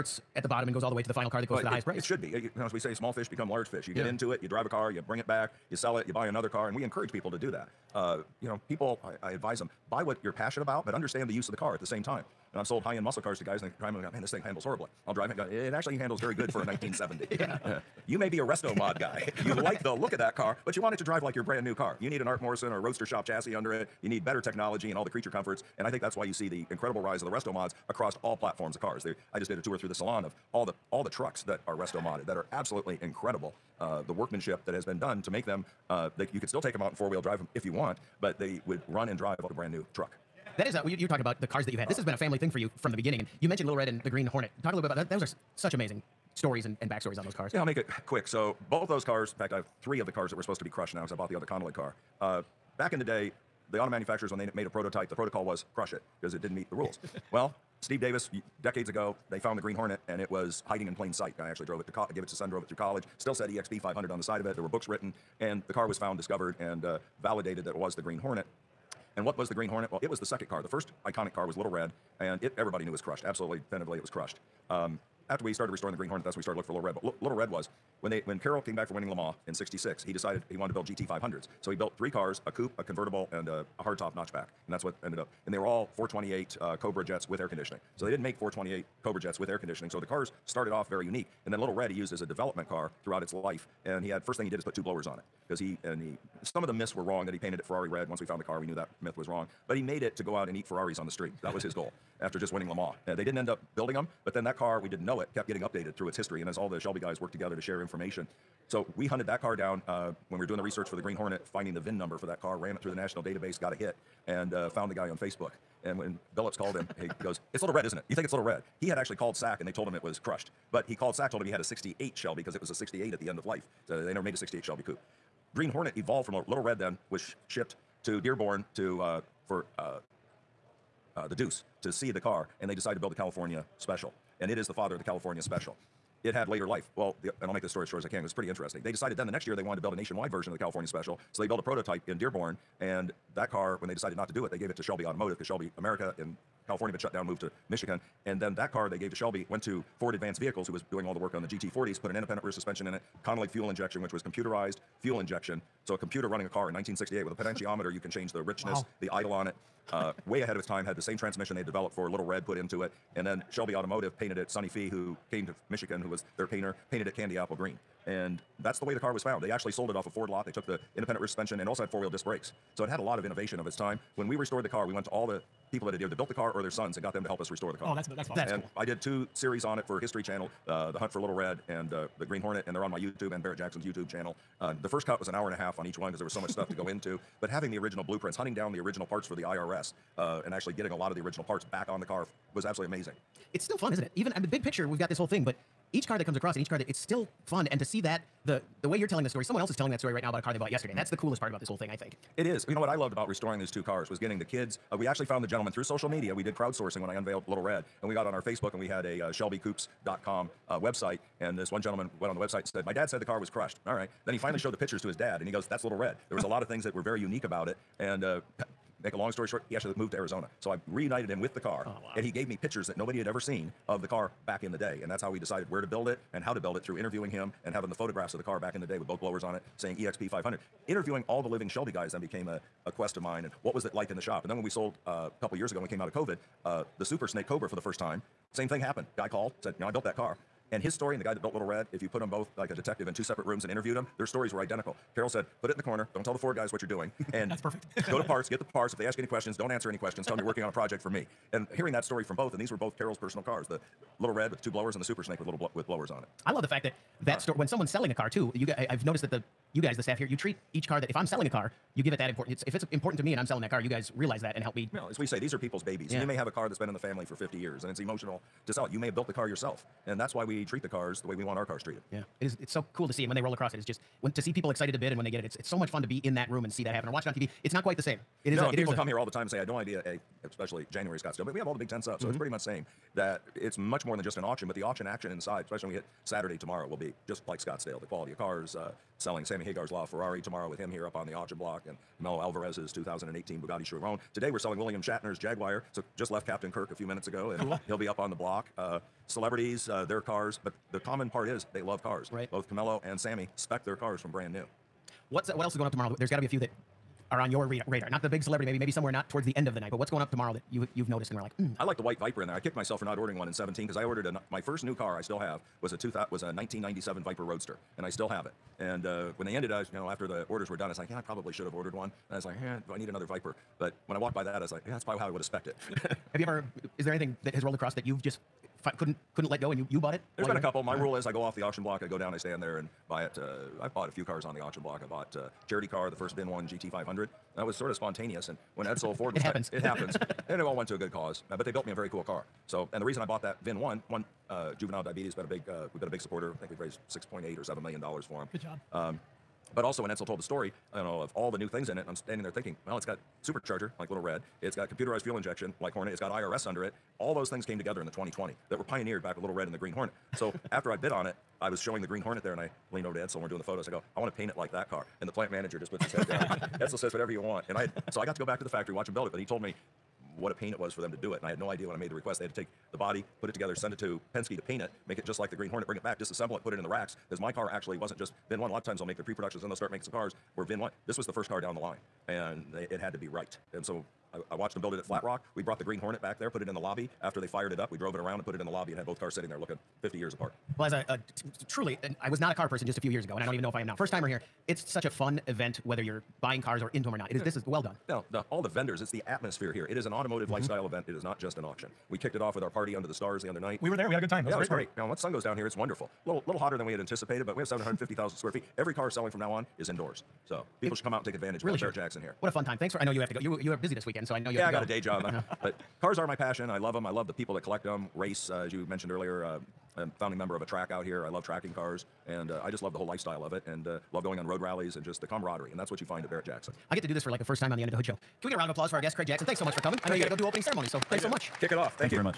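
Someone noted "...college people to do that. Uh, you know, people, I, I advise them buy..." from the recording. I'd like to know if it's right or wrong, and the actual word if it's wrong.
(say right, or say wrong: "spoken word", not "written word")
wrong: "encourage", not "college".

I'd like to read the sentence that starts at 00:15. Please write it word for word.
Go, it actually handles very good for a 1970.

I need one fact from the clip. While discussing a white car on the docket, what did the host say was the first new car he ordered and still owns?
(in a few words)
1997 Viper Roadster.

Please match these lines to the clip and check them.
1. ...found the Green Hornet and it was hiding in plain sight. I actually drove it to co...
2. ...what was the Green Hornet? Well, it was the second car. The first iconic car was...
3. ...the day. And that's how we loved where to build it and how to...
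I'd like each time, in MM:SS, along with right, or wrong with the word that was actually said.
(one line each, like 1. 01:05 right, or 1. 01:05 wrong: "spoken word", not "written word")
1. 00:59 right
2. 01:09 right
3. 03:44 wrong: "decided", not "loved".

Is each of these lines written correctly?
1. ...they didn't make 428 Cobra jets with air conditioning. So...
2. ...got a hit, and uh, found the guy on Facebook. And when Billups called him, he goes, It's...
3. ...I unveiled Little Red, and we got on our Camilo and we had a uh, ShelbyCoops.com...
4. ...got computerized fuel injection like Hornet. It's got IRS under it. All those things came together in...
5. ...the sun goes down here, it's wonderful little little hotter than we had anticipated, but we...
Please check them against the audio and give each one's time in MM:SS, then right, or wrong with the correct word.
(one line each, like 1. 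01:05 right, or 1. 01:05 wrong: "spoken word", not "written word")
1. 01:28 right
2. 01:53 right
3. 03:27 wrong: "Facebook", not "Camilo"
4. 05:54 right
5. 06:45 right.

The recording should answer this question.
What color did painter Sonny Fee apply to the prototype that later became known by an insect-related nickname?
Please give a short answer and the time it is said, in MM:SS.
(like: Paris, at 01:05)
Candy apple green, at 02:47.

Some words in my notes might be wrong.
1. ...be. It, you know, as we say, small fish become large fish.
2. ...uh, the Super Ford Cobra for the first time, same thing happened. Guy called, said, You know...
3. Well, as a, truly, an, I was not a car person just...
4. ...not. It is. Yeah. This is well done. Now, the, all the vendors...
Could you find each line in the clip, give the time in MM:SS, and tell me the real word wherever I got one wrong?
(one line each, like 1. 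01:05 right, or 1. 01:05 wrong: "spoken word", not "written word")
1. 00:02 right
2. 03:56 wrong: "Snake", not "Ford"
3. 06:30 right
4. 06:37 right.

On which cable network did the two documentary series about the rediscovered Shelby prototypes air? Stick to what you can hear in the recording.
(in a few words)
History Channel.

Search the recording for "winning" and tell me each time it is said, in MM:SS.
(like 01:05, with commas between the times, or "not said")
01:18, 01:42.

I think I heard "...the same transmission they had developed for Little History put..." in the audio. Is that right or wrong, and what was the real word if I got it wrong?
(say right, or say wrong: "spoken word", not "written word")
wrong: "Red", not "History".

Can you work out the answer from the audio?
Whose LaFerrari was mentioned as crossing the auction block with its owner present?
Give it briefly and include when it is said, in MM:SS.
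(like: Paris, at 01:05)
Sammy Hagar, at 04:49.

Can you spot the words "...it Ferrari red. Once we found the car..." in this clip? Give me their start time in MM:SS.
01:37.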